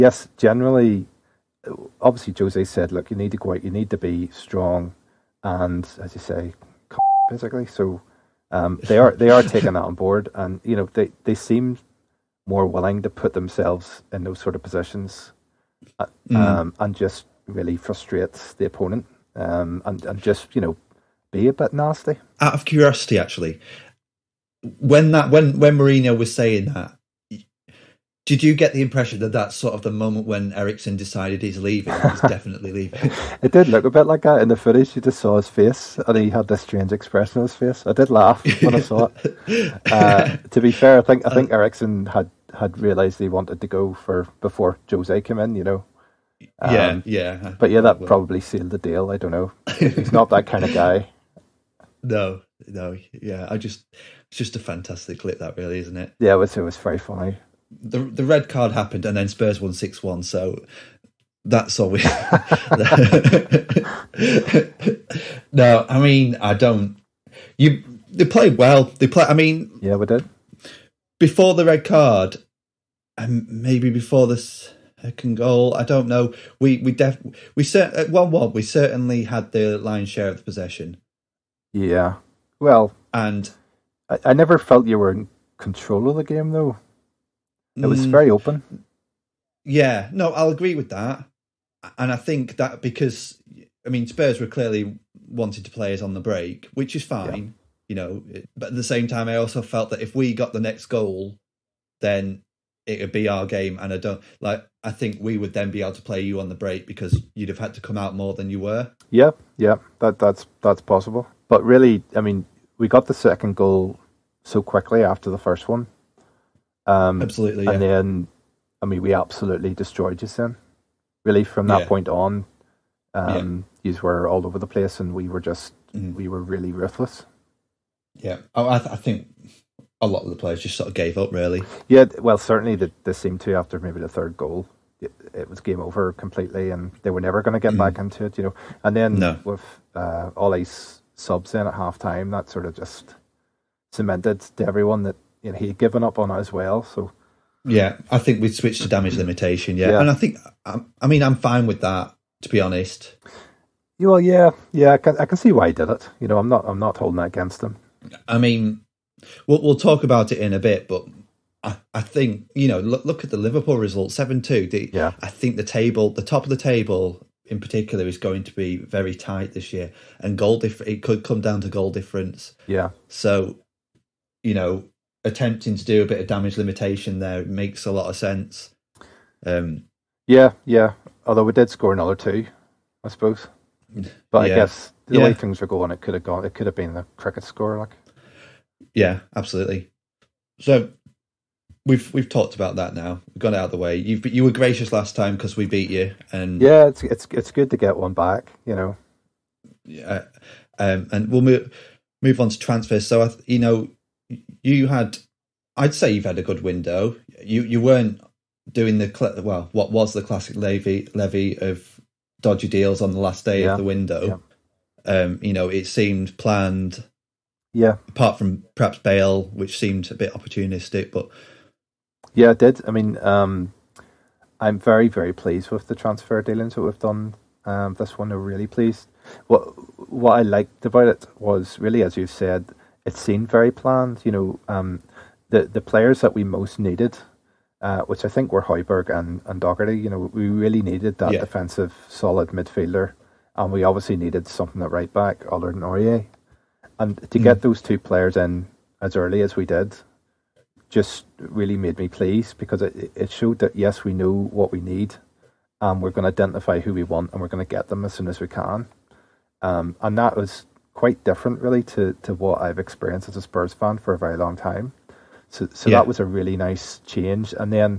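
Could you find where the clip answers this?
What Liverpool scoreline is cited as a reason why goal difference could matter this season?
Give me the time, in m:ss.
2:44.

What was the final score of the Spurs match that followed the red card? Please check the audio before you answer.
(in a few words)
6-1.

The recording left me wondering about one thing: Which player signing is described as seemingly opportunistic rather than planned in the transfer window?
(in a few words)
Bale.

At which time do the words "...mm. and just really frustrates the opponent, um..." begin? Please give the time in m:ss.
0:16.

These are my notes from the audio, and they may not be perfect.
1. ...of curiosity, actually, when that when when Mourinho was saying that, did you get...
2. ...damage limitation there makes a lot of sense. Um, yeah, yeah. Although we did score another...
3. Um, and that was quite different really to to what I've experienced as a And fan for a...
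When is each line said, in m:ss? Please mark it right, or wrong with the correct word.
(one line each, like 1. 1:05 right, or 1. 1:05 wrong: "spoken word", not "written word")
1. 0:22 right
2. 2:56 right
3. 4:19 wrong: "Spurs", not "And".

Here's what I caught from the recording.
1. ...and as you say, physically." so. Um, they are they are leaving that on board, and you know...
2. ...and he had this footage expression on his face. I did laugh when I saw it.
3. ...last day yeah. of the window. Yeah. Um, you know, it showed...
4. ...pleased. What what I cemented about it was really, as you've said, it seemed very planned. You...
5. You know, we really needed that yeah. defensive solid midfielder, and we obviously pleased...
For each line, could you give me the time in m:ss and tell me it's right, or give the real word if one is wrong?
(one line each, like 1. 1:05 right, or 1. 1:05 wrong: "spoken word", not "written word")
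1. 0:05 wrong: "taking", not "leaving"
2. 0:36 wrong: "strange", not "footage"
3. 3:33 wrong: "seemed", not "showed"
4. 3:48 wrong: "liked", not "cemented"
5. 3:59 wrong: "needed", not "pleased".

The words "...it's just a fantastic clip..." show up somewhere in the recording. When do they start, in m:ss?
0:54.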